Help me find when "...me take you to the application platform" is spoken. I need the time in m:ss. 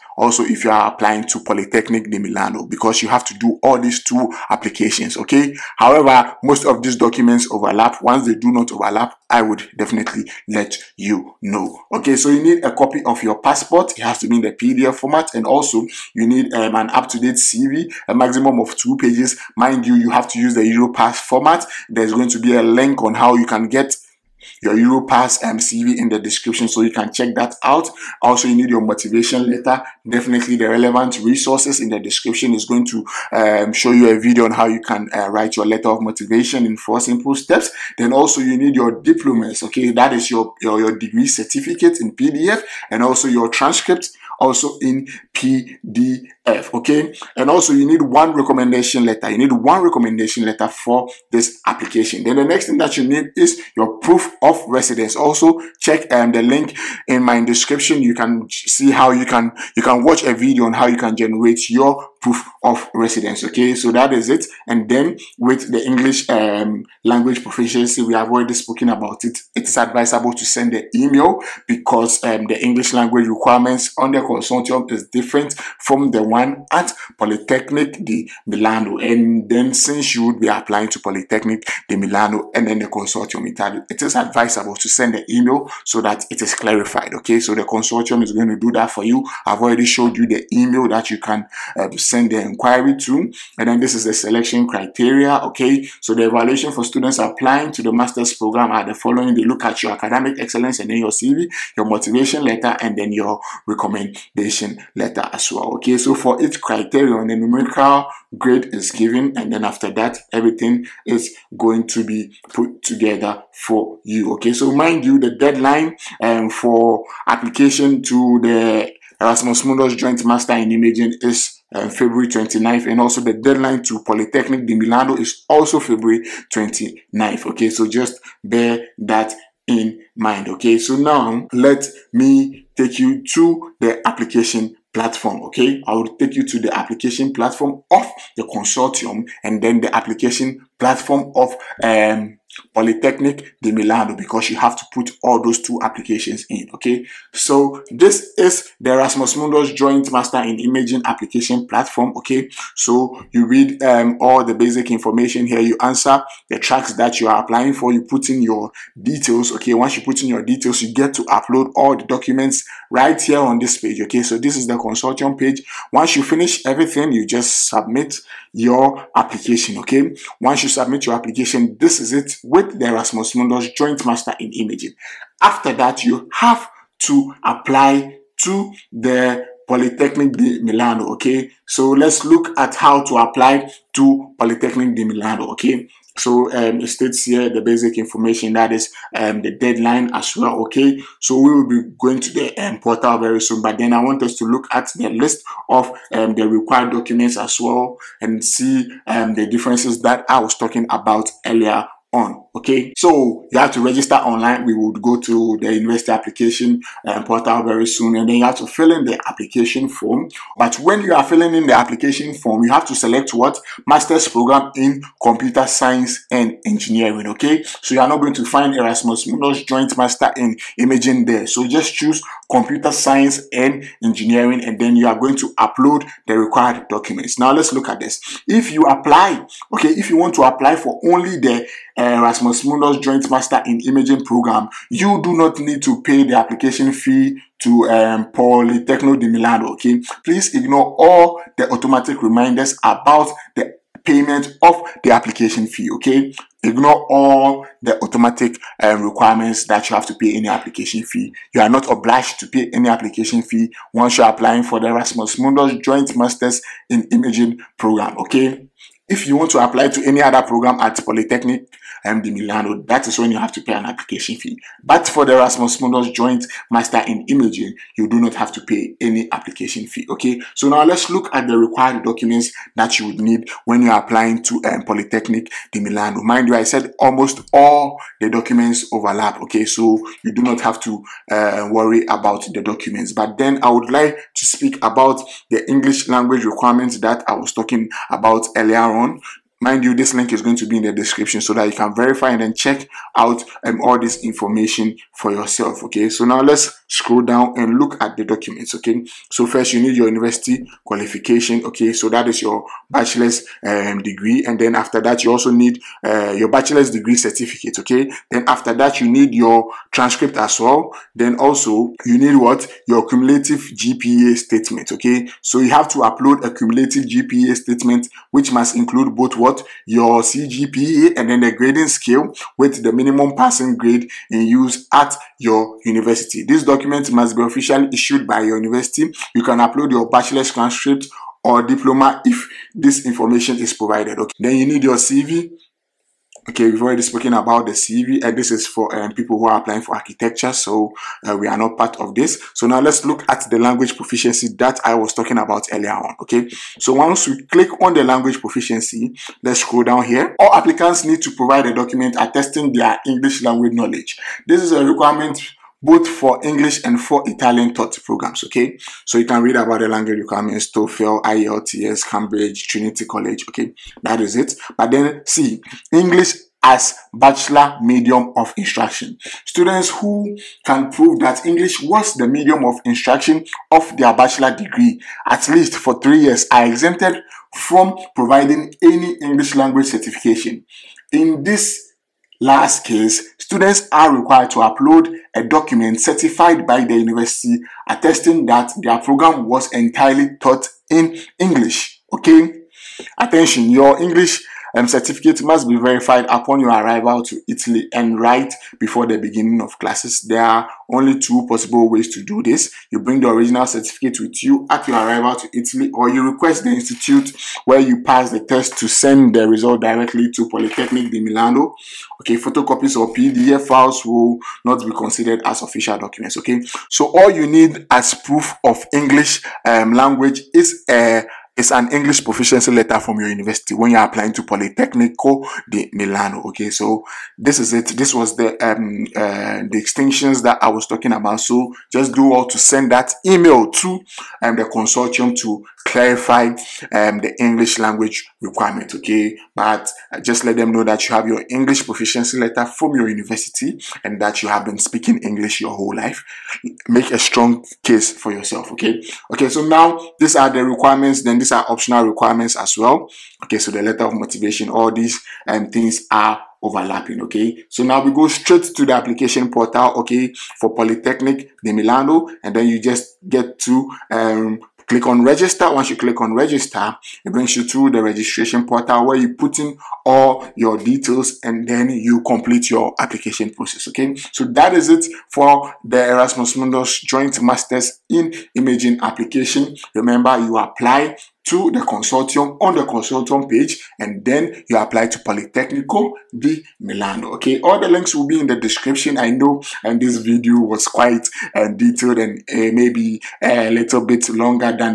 2:12.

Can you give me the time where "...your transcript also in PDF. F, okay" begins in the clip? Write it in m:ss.
0:43.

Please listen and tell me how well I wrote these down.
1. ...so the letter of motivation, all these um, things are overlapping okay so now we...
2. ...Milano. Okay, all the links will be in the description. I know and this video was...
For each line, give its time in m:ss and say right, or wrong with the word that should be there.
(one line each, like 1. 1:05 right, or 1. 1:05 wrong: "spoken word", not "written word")
1. 7:33 right
2. 8:06 right.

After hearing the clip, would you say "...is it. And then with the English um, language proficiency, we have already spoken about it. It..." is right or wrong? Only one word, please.
right.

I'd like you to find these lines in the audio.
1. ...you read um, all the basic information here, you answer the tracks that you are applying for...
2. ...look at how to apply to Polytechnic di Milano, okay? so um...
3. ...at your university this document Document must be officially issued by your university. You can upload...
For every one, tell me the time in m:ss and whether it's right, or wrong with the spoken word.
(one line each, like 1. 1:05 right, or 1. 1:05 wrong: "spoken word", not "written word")
1. 2:33 right
2. 3:02 right
3. 5:24 right.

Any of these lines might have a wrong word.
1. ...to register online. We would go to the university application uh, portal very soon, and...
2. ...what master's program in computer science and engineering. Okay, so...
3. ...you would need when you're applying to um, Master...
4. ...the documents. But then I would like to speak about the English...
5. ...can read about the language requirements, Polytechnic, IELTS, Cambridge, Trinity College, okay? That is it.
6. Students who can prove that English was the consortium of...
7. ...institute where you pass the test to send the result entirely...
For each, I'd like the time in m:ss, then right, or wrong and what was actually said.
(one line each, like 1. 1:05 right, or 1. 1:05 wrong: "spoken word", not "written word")
1. 3:23 right
2. 3:33 right
3. 4:32 wrong: "Polytechnic", not "Master"
4. 4:42 right
5. 5:59 wrong: "TOEFL", not "Polytechnic"
6. 6:09 wrong: "medium", not "consortium"
7. 6:46 wrong: "directly", not "entirely".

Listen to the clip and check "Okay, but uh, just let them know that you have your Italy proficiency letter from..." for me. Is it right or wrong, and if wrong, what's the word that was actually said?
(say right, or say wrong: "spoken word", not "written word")
wrong: "English", not "Italy".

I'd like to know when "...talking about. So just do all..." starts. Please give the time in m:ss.
7:10.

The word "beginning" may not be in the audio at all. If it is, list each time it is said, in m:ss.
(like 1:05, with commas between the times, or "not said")
6:39.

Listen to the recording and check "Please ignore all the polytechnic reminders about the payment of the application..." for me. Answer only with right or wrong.
wrong.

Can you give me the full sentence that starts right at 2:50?
Once you submit your application, this is it with the Erasmus Mundus Joint Master in Imaging.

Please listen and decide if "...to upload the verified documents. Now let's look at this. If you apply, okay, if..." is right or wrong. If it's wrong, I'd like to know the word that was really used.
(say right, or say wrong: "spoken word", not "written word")
wrong: "required", not "verified".